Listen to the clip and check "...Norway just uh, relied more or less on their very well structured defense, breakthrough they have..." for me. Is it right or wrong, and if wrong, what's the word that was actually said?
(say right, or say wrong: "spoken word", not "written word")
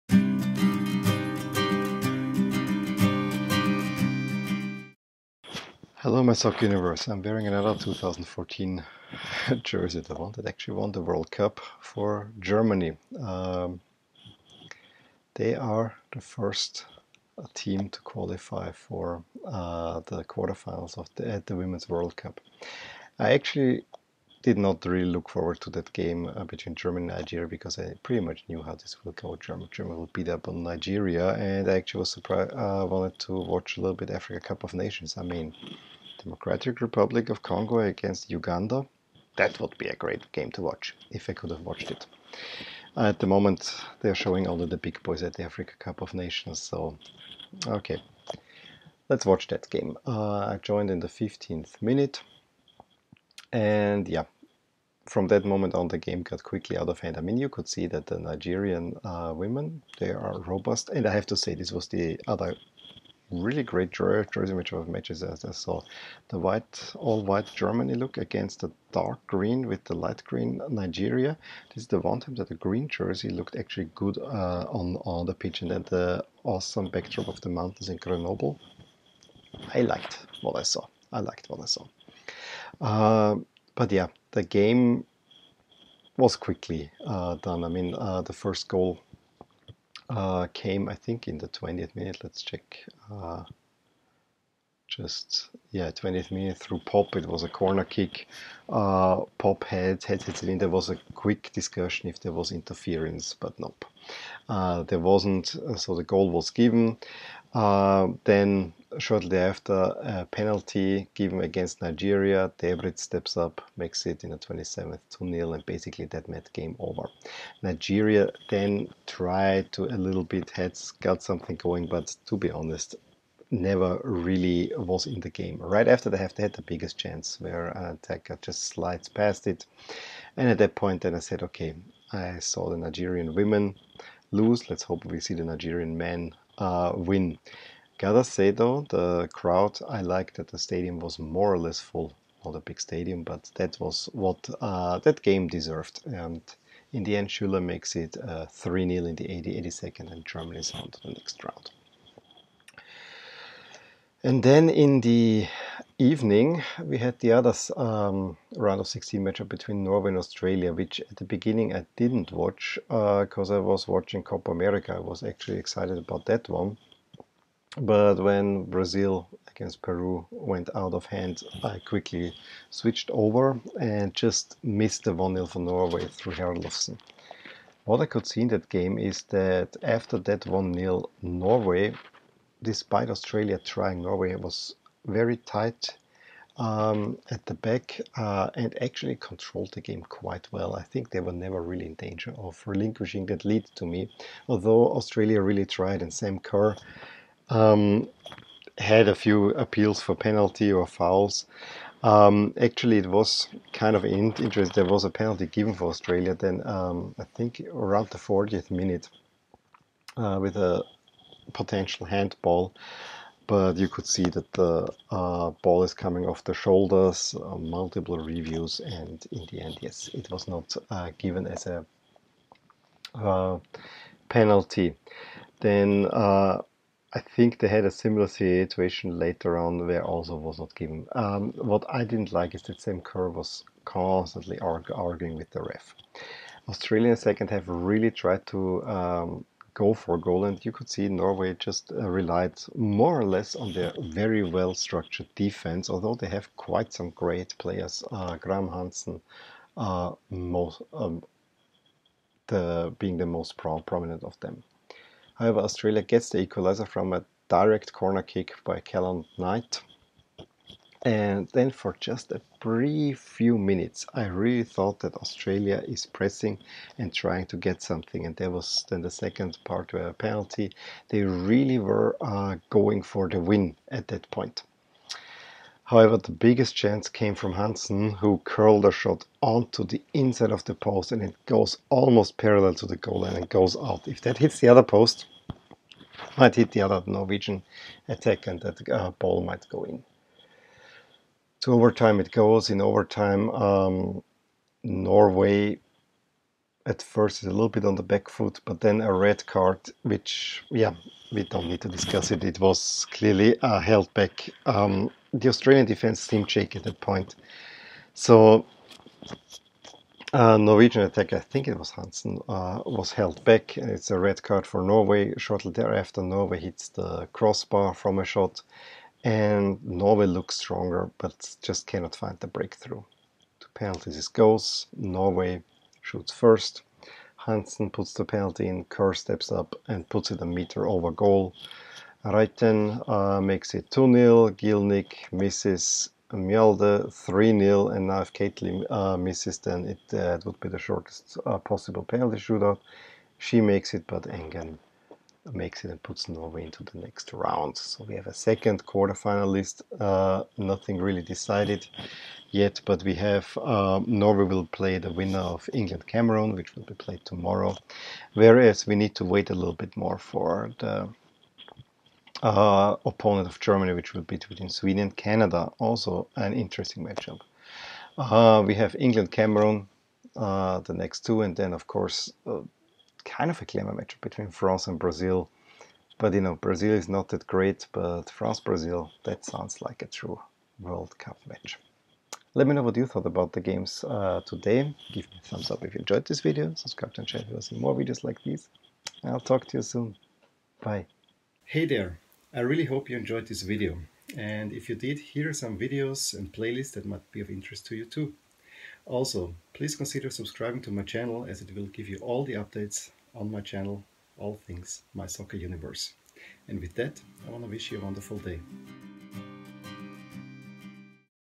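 wrong: "although", not "breakthrough".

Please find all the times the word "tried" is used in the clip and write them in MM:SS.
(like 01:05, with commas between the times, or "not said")
01:59, 03:15, 03:58.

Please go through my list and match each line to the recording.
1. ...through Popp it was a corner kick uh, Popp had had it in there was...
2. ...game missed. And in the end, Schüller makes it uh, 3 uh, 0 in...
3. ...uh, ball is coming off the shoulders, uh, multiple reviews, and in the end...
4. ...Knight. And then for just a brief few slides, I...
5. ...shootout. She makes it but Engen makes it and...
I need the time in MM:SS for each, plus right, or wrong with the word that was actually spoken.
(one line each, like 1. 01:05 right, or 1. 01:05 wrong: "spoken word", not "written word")
1. 01:36 right
2. 02:25 wrong: "deserved", not "missed"
3. 03:35 right
4. 04:19 wrong: "minutes", not "slides"
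5. 05:42 right.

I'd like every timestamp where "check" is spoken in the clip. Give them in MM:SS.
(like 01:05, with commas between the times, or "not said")
01:32.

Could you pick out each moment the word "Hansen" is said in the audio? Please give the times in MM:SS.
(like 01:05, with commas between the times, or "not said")
04:08, 04:37, 05:11, 05:27.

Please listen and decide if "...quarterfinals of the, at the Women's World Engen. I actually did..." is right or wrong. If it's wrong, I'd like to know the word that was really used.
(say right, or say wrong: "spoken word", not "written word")
wrong: "Cup", not "Engen".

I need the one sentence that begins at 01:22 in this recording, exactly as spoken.
Uh, but yeah, the game was quickly uh, done.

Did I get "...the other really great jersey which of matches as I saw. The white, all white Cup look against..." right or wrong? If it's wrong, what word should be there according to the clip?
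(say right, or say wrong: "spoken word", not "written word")
wrong: "Germany", not "Cup".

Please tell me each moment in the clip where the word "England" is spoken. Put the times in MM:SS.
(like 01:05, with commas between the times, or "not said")
05:55, 06:08.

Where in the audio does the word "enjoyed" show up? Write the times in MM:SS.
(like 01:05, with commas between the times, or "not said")
06:25, 06:33.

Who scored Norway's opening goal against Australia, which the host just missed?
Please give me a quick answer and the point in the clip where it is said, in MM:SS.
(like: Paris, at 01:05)
Herlofsen, at 02:56.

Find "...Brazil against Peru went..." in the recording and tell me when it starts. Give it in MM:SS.
02:48.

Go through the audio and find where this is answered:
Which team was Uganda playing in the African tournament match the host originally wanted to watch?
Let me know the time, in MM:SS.
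00:36.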